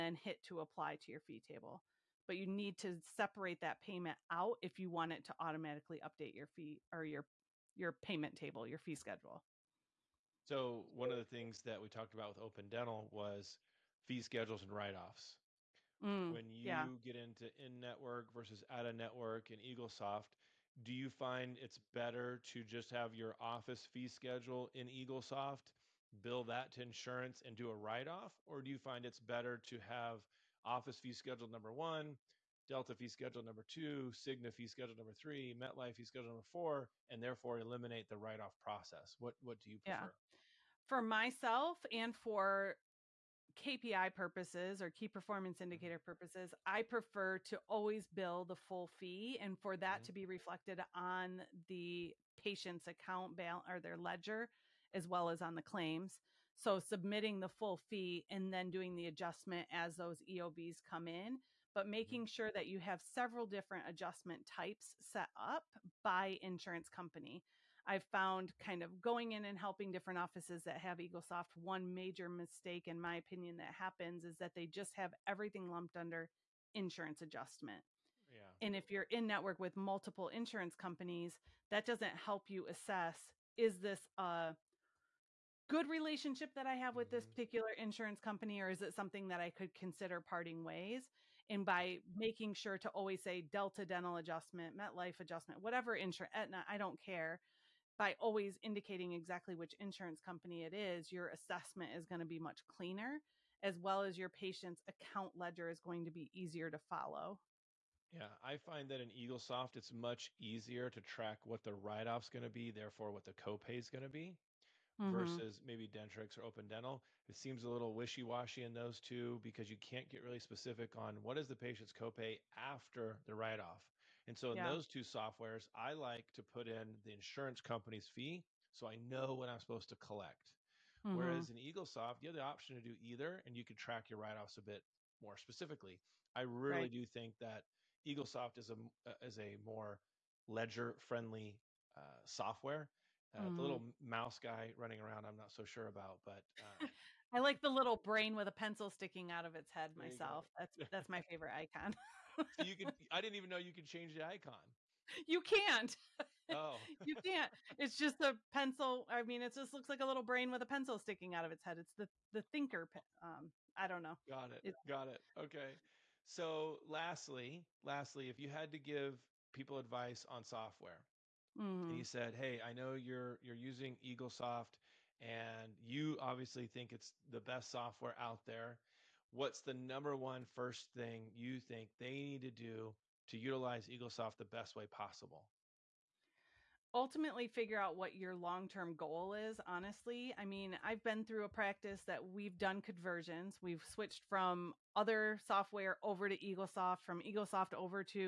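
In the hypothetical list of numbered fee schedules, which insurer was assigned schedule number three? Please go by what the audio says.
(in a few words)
Cigna.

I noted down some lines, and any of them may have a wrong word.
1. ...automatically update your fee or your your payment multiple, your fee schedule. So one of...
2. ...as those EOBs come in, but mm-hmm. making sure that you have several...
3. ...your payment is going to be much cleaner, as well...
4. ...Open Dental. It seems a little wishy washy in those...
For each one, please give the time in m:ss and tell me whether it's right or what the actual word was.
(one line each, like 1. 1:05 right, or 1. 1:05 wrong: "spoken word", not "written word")
1. 0:05 wrong: "table", not "multiple"
2. 0:59 right
3. 1:41 wrong: "assessment", not "payment"
4. 1:56 right.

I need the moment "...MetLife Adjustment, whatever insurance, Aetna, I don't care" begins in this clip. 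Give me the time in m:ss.
1:34.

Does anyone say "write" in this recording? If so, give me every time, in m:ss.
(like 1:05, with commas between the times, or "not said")
0:14, 0:27, 0:38, 1:51, 2:03, 2:14.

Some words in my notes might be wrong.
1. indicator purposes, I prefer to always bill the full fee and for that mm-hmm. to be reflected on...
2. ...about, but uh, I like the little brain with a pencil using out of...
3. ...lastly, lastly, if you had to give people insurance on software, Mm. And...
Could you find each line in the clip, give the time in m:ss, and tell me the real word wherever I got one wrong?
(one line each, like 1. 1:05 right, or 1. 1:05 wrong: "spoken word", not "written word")
1. 0:45 right
2. 2:25 wrong: "sticking", not "using"
3. 2:46 wrong: "advice", not "insurance".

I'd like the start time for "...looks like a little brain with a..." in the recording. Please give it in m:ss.
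2:39.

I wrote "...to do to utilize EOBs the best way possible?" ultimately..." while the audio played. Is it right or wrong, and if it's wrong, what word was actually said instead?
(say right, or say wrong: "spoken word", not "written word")
wrong: "EagleSoft", not "EOBs".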